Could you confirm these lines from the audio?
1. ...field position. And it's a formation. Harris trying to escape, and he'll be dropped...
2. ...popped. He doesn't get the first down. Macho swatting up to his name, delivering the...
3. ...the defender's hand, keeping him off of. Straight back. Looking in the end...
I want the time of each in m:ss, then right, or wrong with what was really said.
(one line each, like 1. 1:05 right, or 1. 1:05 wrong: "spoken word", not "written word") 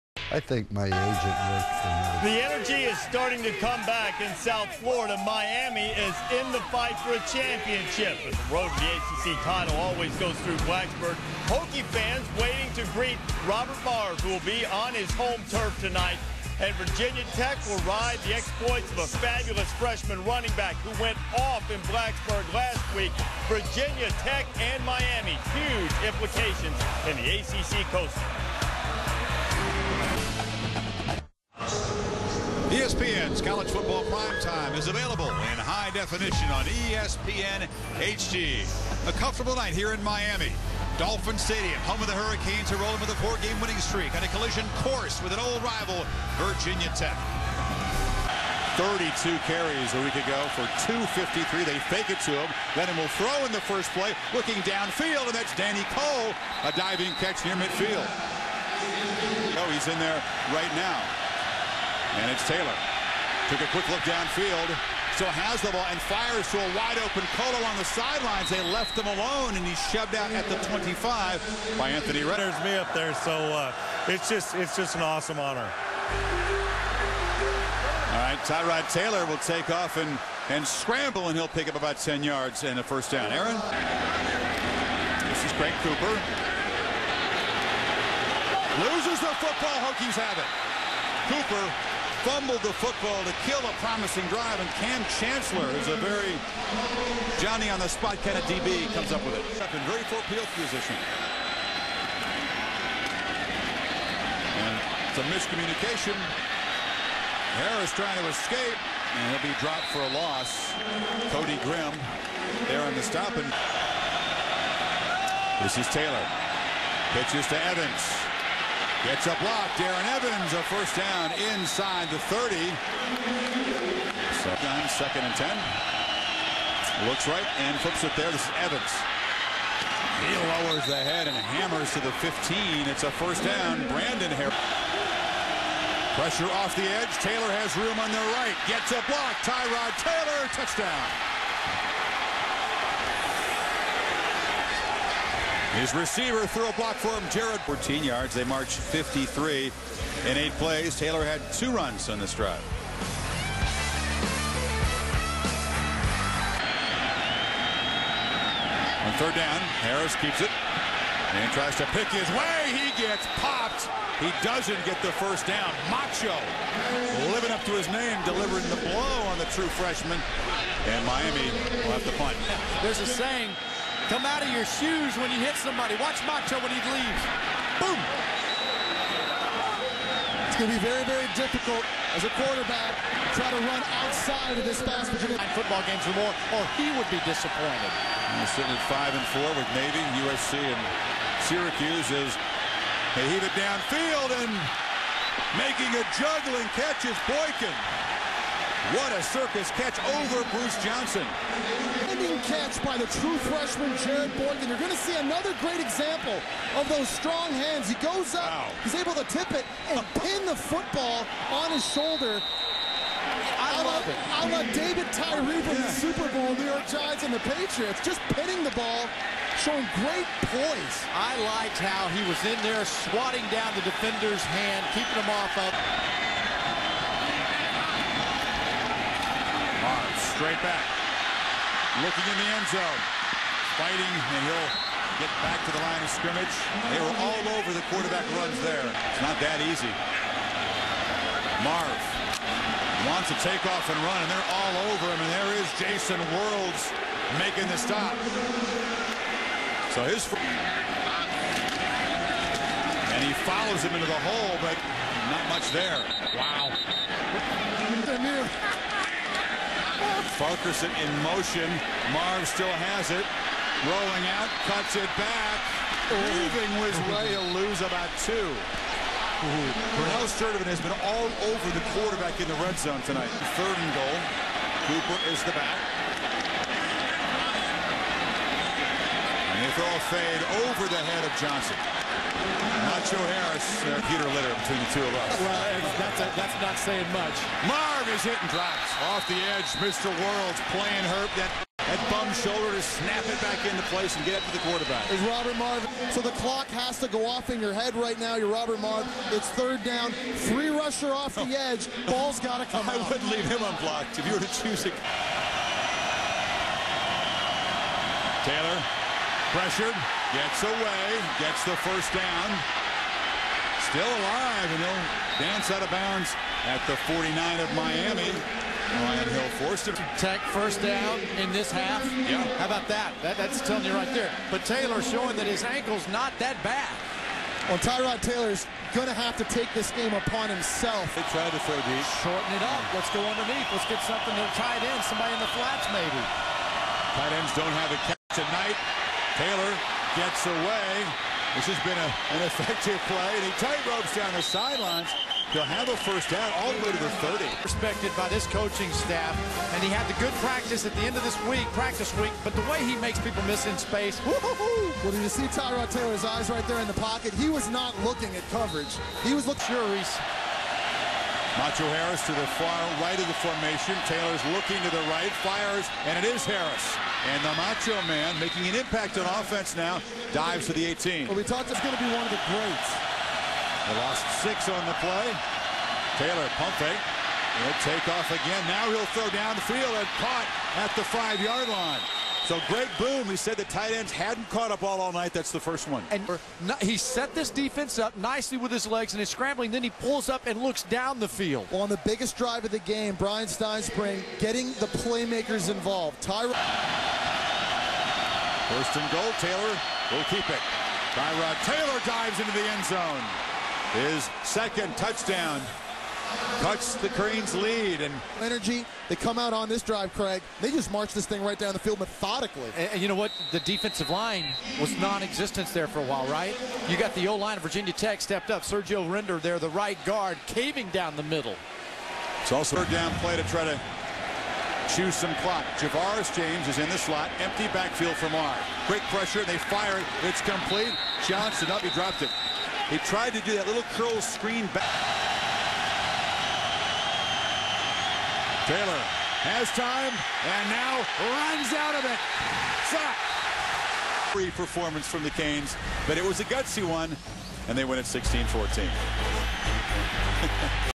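1. 1:40 wrong: "miscommunication", not "formation"
2. 2:43 wrong: "living", not "swatting"
3. 3:43 right.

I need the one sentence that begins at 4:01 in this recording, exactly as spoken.
Marve wants to take off and run, and they're all over him, and there is Jason Worilds making the stop.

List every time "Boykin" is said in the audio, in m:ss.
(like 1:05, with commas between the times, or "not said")
3:17, 3:24.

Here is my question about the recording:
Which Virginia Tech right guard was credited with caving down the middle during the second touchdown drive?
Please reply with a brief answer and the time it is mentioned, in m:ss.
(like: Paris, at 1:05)
Sergio Render, at 6:58.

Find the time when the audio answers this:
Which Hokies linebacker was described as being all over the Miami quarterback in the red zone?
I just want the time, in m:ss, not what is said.
4:29.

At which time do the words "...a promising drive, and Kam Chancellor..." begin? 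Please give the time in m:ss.
1:33.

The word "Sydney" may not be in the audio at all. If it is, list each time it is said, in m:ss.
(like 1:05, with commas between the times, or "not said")
not said.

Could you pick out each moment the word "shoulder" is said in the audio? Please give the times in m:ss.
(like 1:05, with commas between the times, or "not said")
3:31, 4:52.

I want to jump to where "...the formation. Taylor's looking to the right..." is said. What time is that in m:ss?
6:03.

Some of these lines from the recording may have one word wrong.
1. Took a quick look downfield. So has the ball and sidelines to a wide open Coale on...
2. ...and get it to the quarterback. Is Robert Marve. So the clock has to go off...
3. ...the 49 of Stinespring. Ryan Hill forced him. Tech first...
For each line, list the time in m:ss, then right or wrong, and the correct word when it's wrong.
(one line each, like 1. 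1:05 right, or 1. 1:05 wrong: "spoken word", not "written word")
1. 1:03 wrong: "fires", not "sidelines"
2. 4:54 right
3. 5:16 wrong: "Miami", not "Stinespring".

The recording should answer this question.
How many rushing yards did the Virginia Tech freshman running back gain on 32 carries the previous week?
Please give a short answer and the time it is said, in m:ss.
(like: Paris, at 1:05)
253, at 0:50.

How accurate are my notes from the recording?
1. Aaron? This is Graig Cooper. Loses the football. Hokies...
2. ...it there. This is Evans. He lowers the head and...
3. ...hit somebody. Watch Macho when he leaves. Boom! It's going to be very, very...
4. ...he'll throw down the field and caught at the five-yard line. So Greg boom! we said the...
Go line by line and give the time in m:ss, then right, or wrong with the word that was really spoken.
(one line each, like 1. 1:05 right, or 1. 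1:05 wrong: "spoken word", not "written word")
1. 1:23 right
2. 2:08 right
3. 2:55 right
4. 6:18 right.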